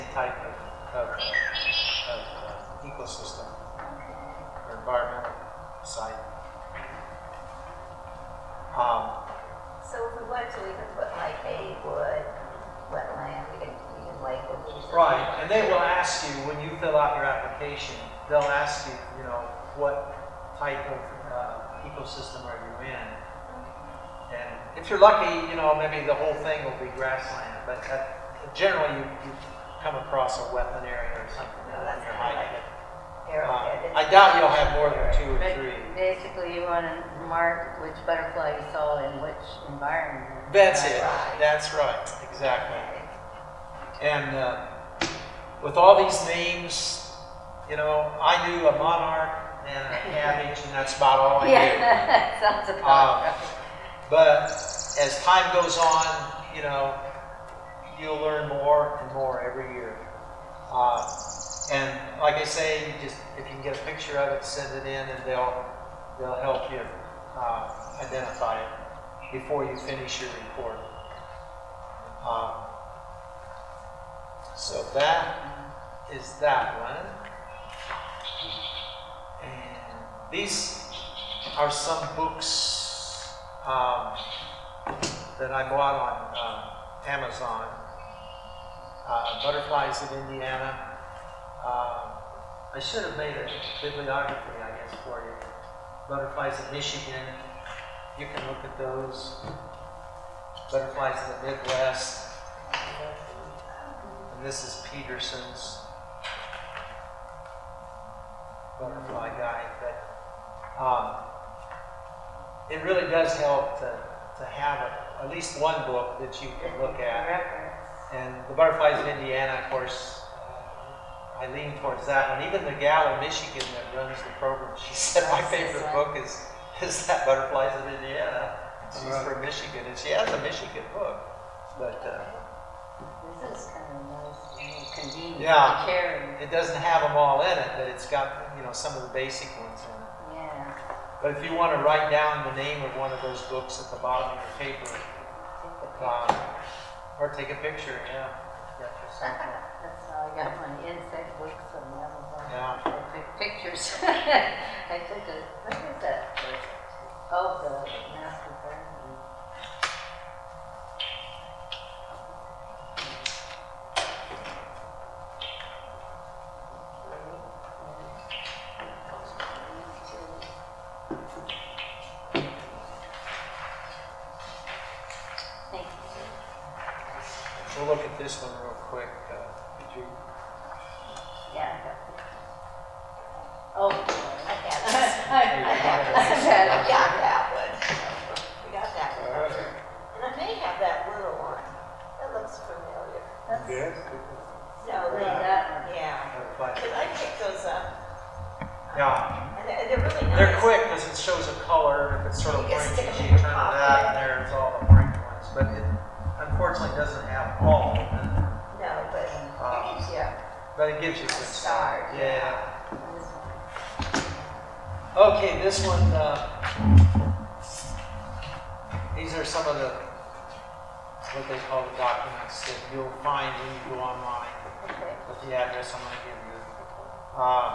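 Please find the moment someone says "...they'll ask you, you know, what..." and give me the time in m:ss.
0:18.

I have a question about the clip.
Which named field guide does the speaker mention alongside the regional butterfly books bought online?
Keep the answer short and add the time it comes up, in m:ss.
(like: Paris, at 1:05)
Peterson's butterfly Guide, at 1:44.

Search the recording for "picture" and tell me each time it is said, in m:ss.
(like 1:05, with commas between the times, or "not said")
1:03, 2:27.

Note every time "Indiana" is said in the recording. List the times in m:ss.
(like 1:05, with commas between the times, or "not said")
1:30, 1:59, 2:07.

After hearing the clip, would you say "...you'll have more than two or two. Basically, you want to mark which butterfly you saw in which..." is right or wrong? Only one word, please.
wrong.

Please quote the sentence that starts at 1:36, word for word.
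Butterflies in Michigan, you can look at those.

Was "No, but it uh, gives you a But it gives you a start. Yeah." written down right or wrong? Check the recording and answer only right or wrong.
right.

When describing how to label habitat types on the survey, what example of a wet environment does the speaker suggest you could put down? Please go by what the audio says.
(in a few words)
wood wetland.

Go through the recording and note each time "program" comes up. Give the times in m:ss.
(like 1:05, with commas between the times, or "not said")
2:04.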